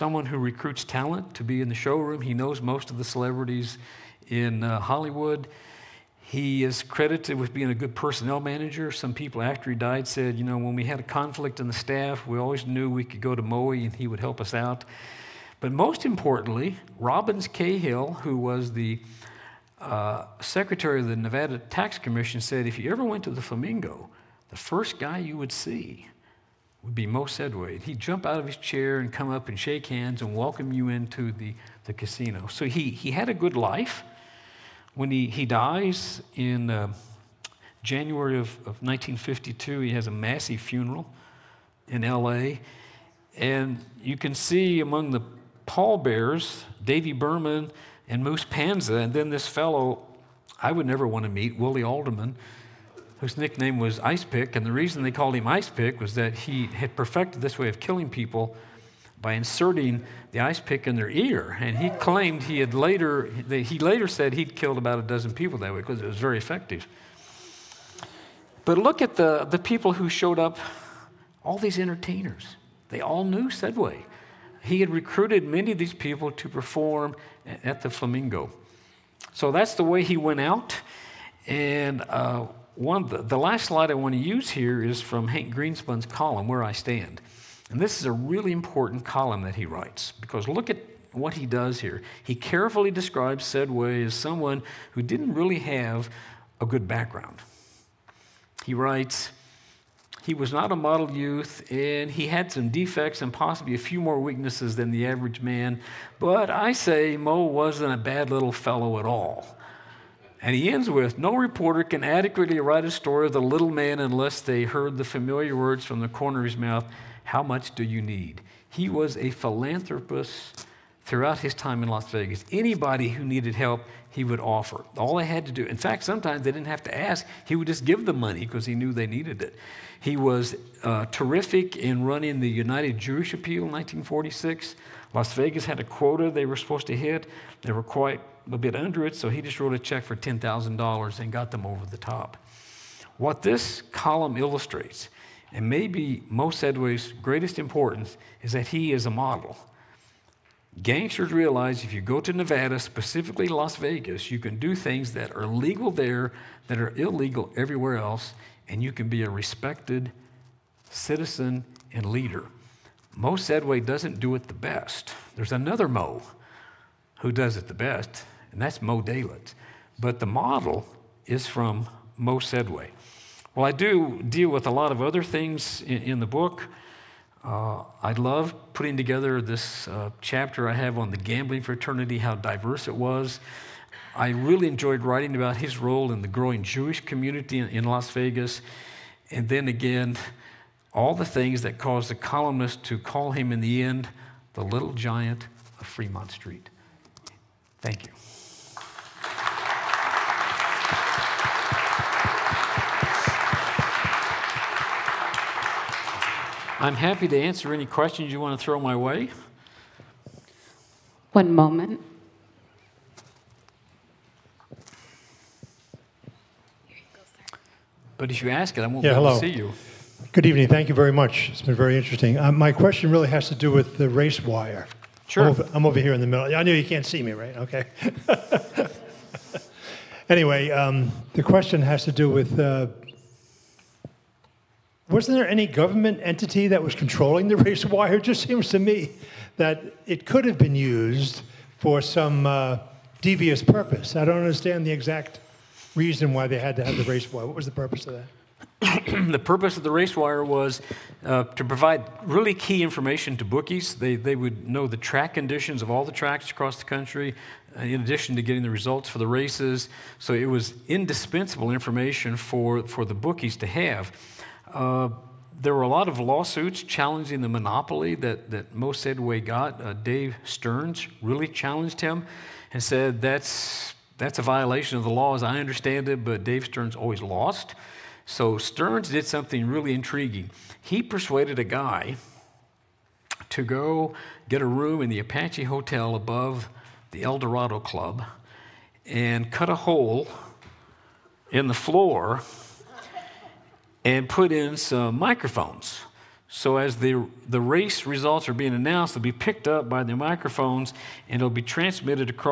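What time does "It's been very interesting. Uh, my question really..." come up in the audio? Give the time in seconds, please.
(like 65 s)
221 s.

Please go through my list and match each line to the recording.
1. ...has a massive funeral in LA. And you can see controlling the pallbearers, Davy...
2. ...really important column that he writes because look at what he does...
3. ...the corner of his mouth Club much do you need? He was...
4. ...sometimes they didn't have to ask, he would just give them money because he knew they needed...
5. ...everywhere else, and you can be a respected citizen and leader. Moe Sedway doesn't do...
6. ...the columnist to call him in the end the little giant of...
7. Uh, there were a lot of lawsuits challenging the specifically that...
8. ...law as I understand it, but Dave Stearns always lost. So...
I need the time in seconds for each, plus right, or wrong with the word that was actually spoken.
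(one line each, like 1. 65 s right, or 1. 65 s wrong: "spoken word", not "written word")
1. 39 s wrong: "among", not "controlling"
2. 88 s right
3. 115 s wrong: "How", not "Club"
4. 126 s right
5. 157 s right
6. 192 s right
7. 264 s wrong: "monopoly", not "specifically"
8. 275 s right.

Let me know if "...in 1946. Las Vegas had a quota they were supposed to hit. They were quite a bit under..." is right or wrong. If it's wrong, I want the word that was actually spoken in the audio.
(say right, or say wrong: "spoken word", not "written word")
right.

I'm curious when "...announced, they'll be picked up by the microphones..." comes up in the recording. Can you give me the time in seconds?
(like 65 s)
298 s.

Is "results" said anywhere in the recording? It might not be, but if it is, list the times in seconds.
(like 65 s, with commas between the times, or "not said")
258 s, 298 s.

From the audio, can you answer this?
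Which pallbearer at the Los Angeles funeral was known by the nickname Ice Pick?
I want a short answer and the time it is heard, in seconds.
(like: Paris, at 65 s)
Willie Alderman, at 51 s.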